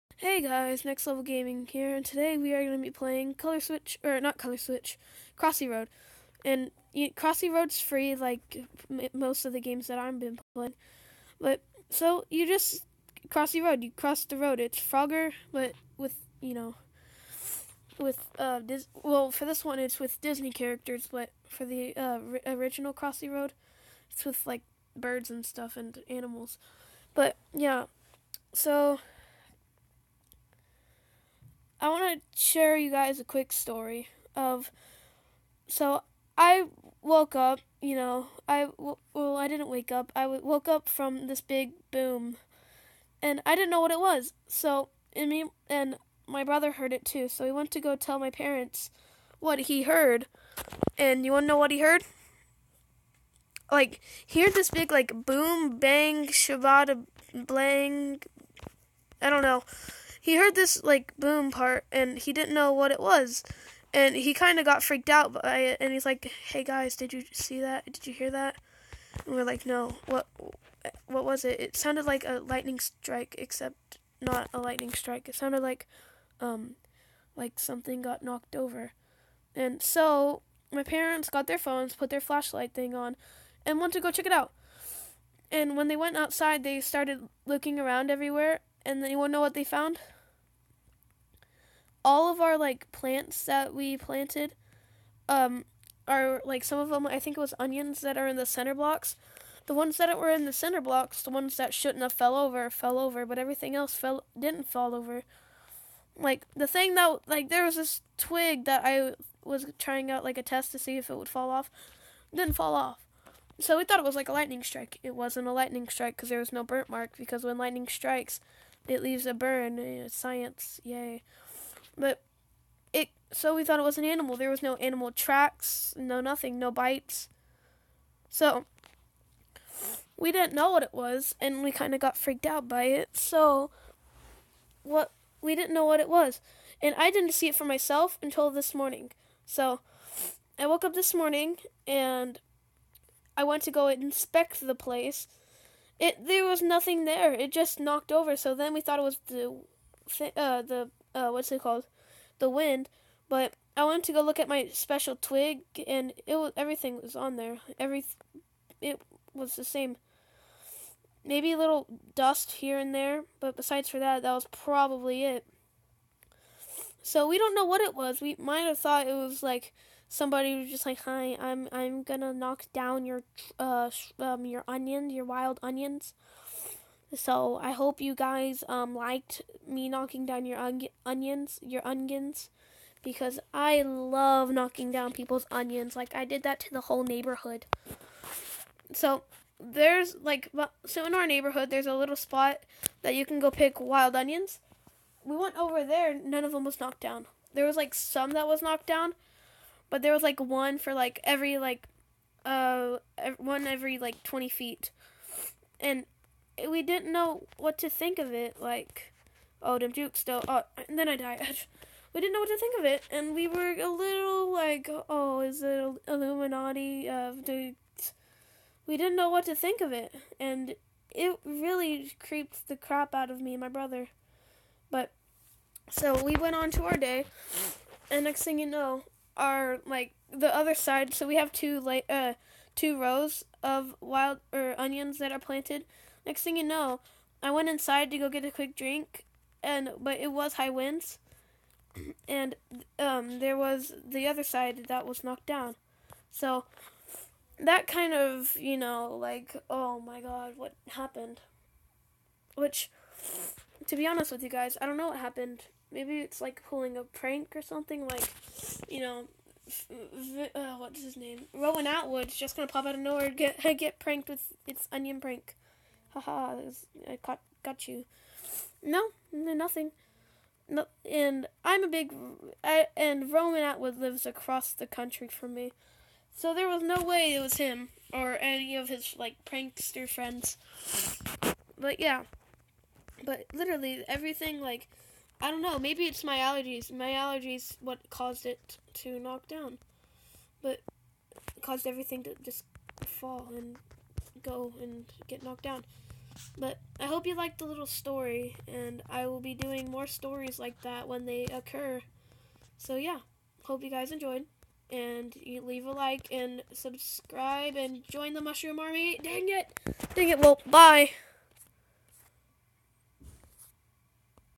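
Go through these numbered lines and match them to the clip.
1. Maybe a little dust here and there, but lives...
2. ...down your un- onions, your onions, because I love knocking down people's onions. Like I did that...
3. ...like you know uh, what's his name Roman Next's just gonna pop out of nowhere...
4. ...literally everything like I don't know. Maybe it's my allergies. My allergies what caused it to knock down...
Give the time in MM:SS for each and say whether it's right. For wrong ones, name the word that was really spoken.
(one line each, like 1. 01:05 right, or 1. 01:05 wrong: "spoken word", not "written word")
1. 02:41 wrong: "besides", not "lives"
2. 03:00 right
3. 04:18 wrong: "Atwood", not "Next"
4. 04:43 right.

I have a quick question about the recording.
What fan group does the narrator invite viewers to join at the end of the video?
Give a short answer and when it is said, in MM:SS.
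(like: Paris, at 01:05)
Mushroom Army, at 05:08.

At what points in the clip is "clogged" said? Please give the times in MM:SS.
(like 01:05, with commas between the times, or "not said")
not said.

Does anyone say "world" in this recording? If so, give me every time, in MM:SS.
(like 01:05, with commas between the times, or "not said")
not said.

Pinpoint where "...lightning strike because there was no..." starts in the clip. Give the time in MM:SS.
01:55.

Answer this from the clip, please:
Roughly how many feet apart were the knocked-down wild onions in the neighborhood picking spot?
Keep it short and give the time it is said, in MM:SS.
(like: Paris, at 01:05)
20 feet, at 03:24.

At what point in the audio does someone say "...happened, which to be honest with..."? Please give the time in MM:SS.
04:10.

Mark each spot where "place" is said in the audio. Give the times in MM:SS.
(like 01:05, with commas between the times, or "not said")
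02:24.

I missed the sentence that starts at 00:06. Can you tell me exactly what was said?
And you, Crossy Road's free, like most of the games that I've been playing.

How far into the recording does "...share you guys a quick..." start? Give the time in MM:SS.
00:32.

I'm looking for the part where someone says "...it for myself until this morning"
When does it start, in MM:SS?
02:17.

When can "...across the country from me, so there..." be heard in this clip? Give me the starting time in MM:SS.
04:34.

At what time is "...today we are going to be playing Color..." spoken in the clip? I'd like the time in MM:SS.
00:02.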